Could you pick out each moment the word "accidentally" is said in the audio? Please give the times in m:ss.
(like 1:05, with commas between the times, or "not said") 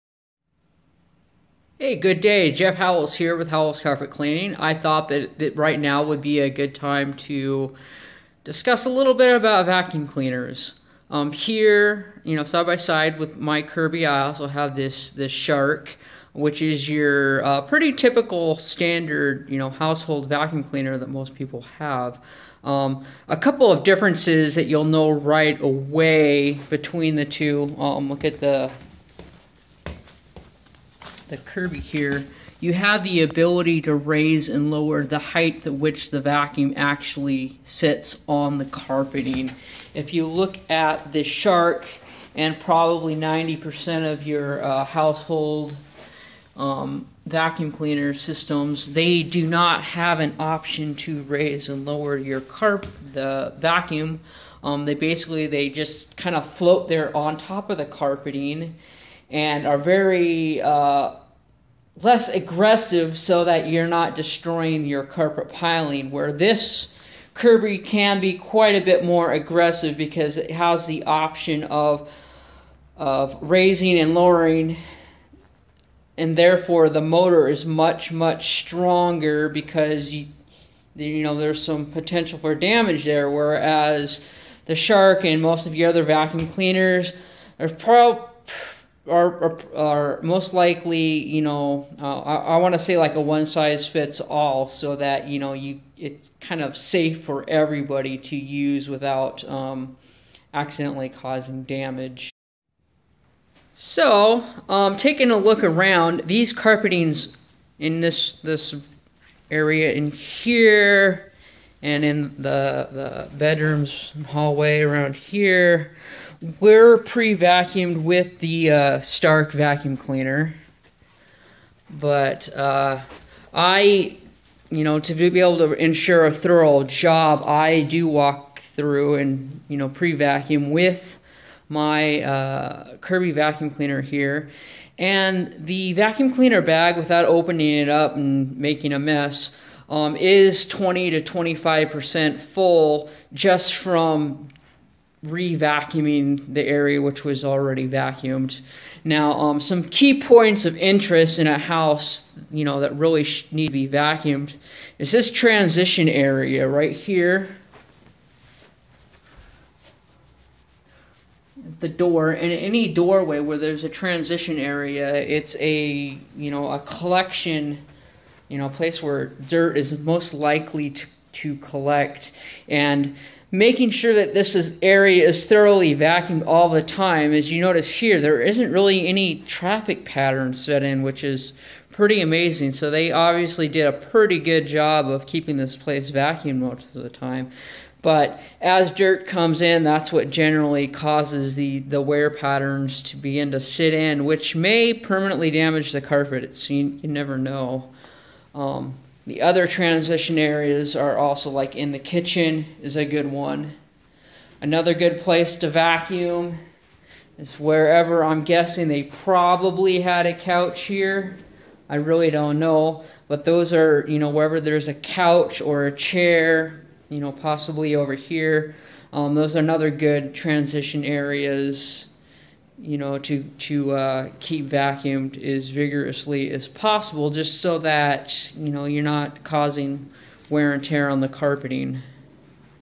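1:40.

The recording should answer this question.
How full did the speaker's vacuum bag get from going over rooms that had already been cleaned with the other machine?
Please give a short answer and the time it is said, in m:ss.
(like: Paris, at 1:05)
20 to 25%, at 2:20.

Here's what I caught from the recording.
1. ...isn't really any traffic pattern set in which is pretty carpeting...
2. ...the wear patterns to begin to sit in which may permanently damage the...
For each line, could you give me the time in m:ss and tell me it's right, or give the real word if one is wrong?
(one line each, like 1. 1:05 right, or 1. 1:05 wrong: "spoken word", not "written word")
1. 2:58 wrong: "amazing", not "carpeting"
2. 3:11 right.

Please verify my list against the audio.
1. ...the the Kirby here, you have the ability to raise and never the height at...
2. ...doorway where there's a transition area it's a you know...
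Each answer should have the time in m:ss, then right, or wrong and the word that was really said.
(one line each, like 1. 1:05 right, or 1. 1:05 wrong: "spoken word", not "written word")
1. 0:28 wrong: "lower", not "never"
2. 2:42 right.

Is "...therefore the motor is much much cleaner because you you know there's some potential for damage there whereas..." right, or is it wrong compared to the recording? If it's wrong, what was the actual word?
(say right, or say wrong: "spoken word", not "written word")
wrong: "stronger", not "cleaner".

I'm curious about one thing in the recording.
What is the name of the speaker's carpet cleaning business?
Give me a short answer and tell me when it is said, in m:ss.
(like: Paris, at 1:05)
Howells Carpet Cleaning, at 0:03.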